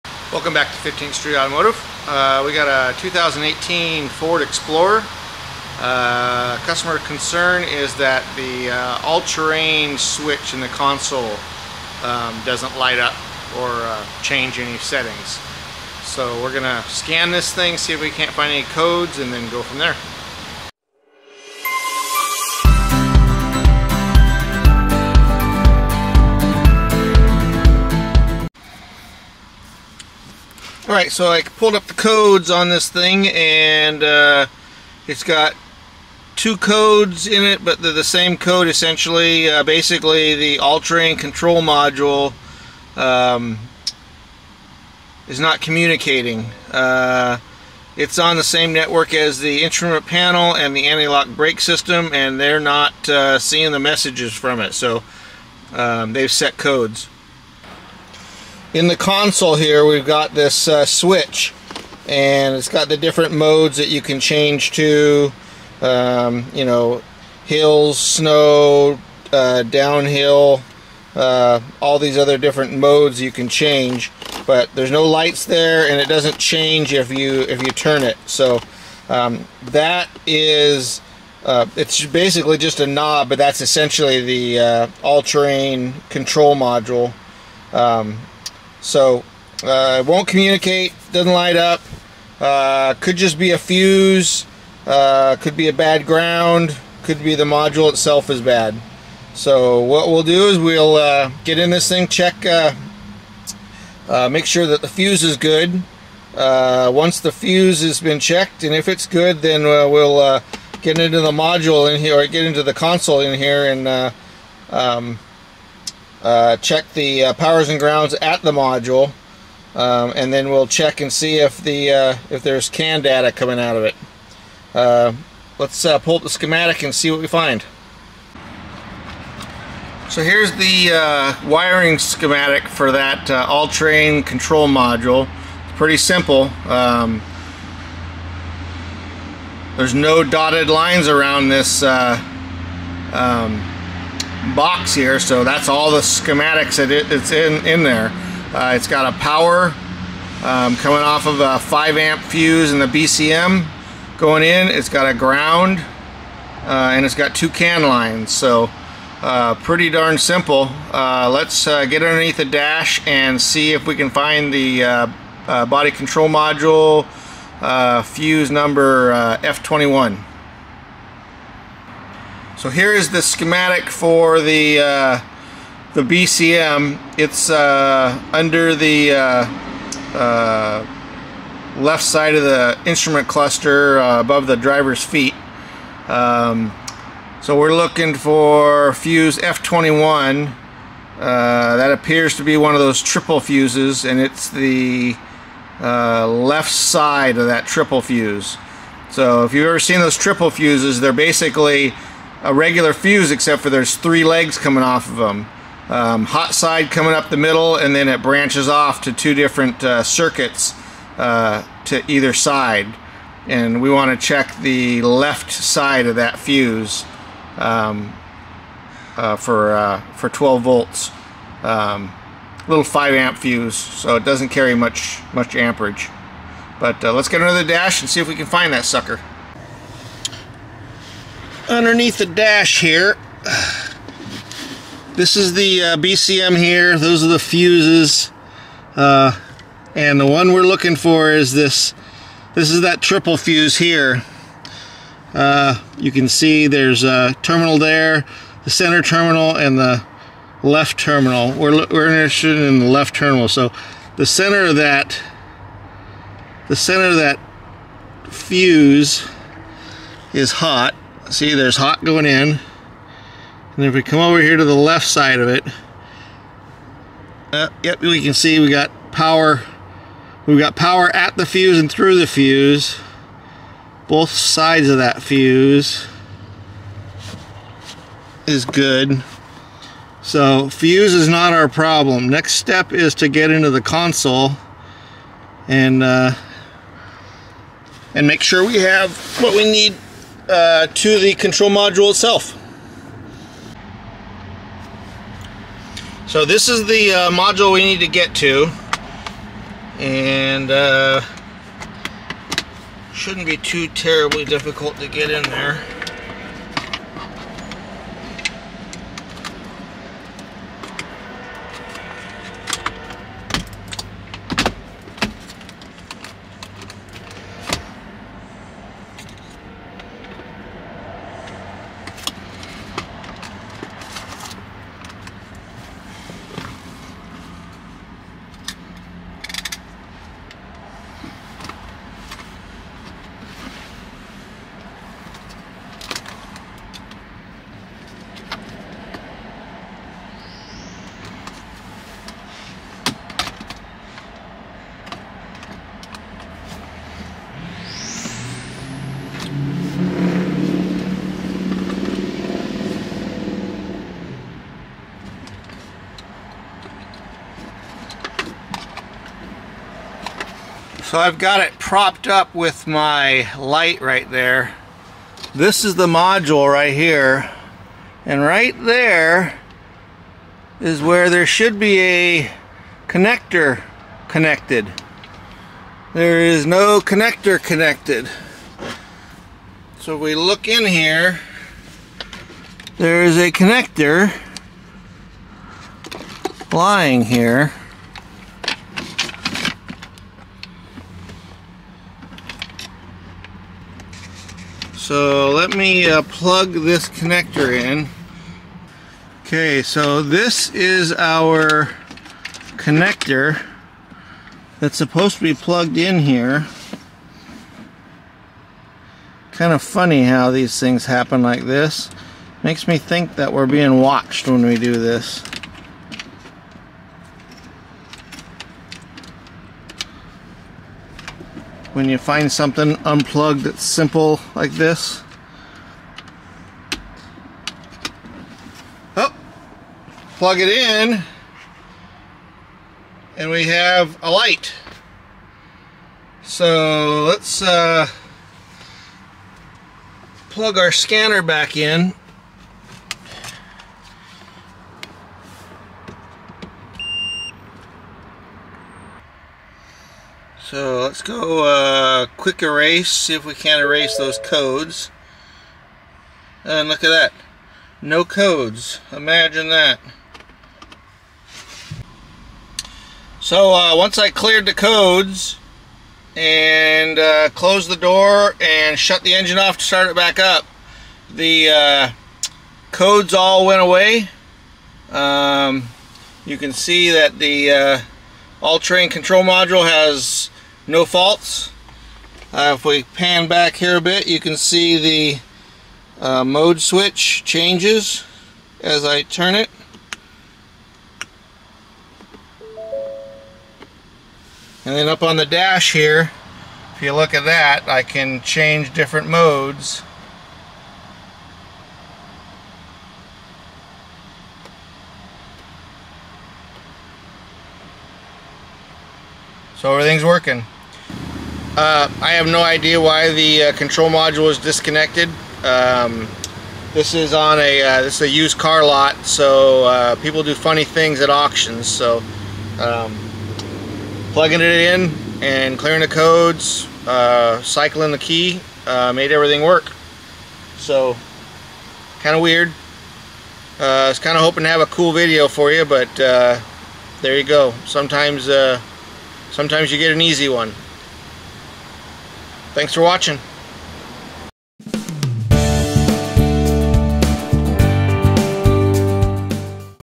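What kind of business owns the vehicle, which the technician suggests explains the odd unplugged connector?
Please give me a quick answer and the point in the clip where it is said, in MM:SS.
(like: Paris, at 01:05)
Used car lot, at 08:38.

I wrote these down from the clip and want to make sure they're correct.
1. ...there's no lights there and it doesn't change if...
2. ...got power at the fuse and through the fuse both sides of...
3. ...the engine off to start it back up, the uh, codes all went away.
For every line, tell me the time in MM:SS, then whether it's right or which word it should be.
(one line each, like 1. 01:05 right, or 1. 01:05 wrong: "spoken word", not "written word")
1. 01:14 right
2. 04:30 right
3. 07:49 right.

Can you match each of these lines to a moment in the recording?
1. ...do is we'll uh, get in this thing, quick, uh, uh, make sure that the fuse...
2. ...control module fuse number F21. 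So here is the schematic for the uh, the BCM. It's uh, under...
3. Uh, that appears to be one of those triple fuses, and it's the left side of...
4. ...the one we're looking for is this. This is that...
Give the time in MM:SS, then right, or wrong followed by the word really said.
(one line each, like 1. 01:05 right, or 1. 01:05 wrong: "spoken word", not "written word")
1. 01:40 wrong: "check", not "quick"
2. 02:45 right
3. 03:11 right
4. 04:00 right.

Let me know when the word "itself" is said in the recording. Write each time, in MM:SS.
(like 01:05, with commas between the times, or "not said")
01:37, 04:52.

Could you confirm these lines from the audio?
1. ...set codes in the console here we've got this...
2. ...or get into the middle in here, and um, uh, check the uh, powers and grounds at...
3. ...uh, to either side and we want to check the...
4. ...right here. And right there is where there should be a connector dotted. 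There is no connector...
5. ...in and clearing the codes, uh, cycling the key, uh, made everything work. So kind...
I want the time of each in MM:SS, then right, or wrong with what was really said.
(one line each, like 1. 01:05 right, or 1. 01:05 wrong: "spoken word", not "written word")
1. 00:56 right
2. 01:52 wrong: "console", not "middle"
3. 03:31 right
4. 06:06 wrong: "connected", not "dotted"
5. 08:44 right.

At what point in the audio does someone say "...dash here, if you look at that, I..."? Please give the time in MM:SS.
08:15.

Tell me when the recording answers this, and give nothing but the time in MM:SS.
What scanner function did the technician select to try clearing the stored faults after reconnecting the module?
07:32.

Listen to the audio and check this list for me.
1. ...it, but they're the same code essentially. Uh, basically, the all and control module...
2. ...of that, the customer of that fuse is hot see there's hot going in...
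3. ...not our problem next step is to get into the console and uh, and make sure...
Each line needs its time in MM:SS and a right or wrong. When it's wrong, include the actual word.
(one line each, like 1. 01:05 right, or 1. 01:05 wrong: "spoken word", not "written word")
1. 00:37 right
2. 04:14 wrong: "center", not "customer"
3. 04:41 right.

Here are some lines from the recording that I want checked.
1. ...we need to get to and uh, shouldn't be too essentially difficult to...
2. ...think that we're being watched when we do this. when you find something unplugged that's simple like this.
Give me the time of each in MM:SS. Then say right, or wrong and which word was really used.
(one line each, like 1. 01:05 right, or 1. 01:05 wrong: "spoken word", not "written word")
1. 04:57 wrong: "terribly", not "essentially"
2. 06:52 right.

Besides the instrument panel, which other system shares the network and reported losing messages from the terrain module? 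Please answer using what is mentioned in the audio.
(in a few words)
Anti-lock brake system.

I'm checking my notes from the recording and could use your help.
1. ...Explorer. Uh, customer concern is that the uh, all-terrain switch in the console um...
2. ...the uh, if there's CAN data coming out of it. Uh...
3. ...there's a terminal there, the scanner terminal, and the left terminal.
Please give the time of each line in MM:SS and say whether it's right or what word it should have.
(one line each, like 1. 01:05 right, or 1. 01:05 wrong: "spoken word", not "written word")
1. 00:04 right
2. 02:01 right
3. 04:06 wrong: "center", not "scanner".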